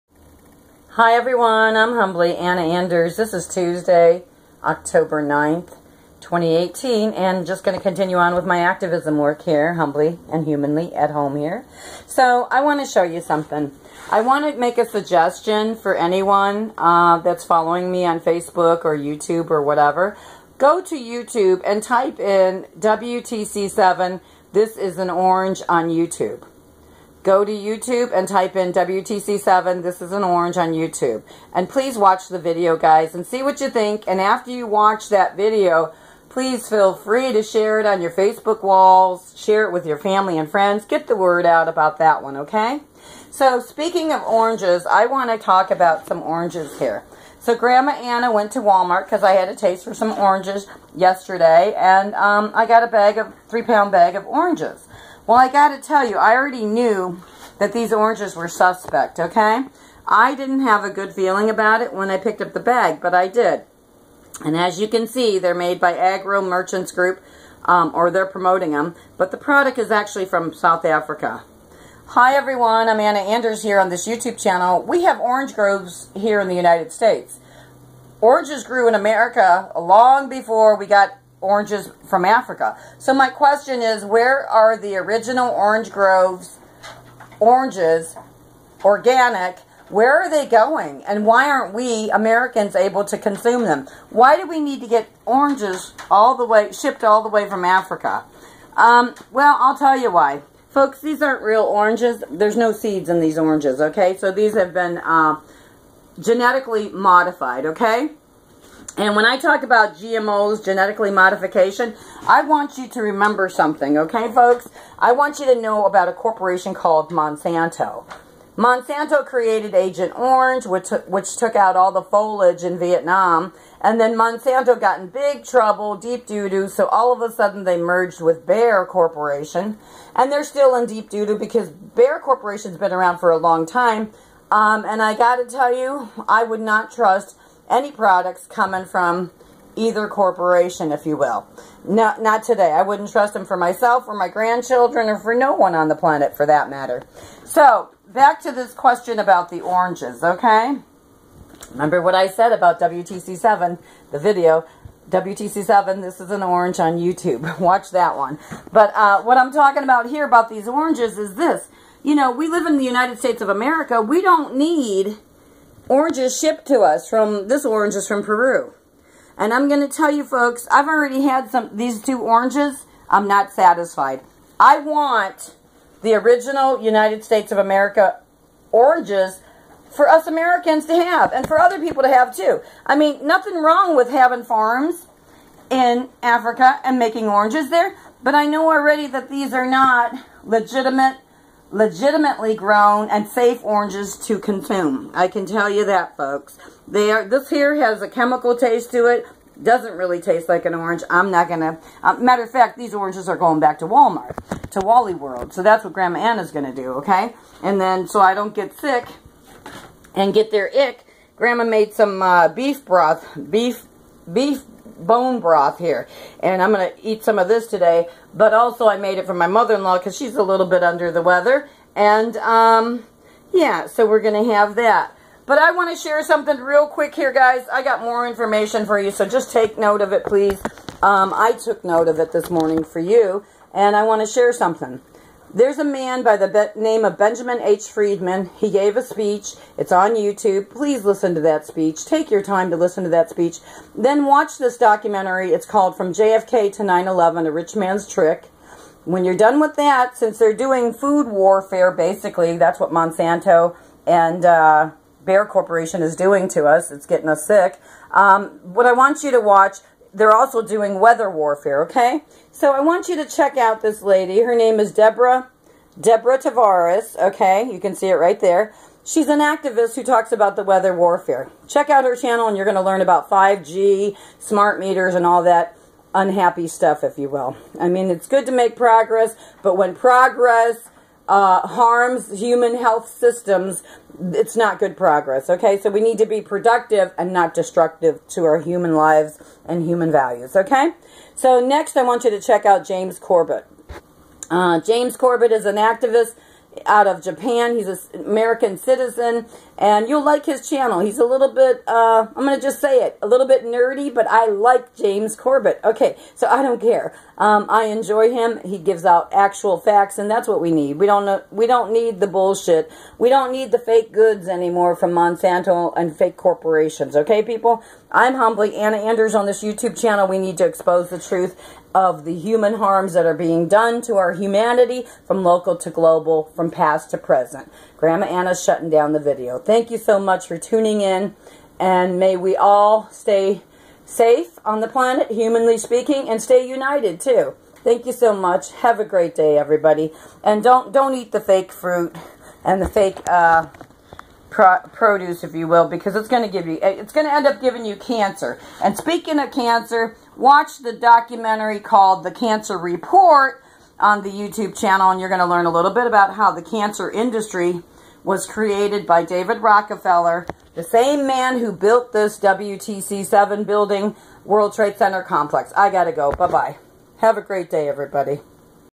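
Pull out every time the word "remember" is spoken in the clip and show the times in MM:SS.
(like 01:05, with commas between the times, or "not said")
01:53, 02:31.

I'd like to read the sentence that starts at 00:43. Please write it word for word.
So speaking of oranges, I want to talk about some oranges here.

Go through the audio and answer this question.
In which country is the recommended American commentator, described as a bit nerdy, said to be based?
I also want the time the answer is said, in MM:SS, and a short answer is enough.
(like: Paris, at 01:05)
Japan, at 04:57.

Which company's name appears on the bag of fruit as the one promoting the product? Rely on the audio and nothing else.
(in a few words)
Agro Merchants Group.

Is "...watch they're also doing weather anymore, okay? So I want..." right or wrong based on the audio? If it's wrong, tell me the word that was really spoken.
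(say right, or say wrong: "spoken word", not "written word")
wrong: "warfare", not "anymore".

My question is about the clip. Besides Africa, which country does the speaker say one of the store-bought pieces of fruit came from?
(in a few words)
Peru.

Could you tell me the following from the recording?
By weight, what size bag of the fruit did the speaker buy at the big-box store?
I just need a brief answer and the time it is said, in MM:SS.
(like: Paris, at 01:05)
3 pounds, at 00:53.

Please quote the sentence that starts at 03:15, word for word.
I can tell you that, folks.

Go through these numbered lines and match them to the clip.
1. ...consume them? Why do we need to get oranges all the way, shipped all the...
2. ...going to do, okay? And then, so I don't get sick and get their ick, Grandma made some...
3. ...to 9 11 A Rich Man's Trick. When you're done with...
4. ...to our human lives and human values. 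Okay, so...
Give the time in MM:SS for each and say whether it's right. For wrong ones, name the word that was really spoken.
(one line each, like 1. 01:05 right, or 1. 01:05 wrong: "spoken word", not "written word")
1. 01:33 right
2. 03:26 right
3. 04:06 right
4. 04:48 right.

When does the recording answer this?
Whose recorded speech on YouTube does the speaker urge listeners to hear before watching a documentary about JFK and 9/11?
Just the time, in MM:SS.
03:57.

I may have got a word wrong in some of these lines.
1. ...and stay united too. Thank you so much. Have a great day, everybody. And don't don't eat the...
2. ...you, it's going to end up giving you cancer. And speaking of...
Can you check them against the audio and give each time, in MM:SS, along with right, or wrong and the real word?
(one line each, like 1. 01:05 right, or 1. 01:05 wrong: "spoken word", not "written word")
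1. 05:36 right
2. 05:46 right.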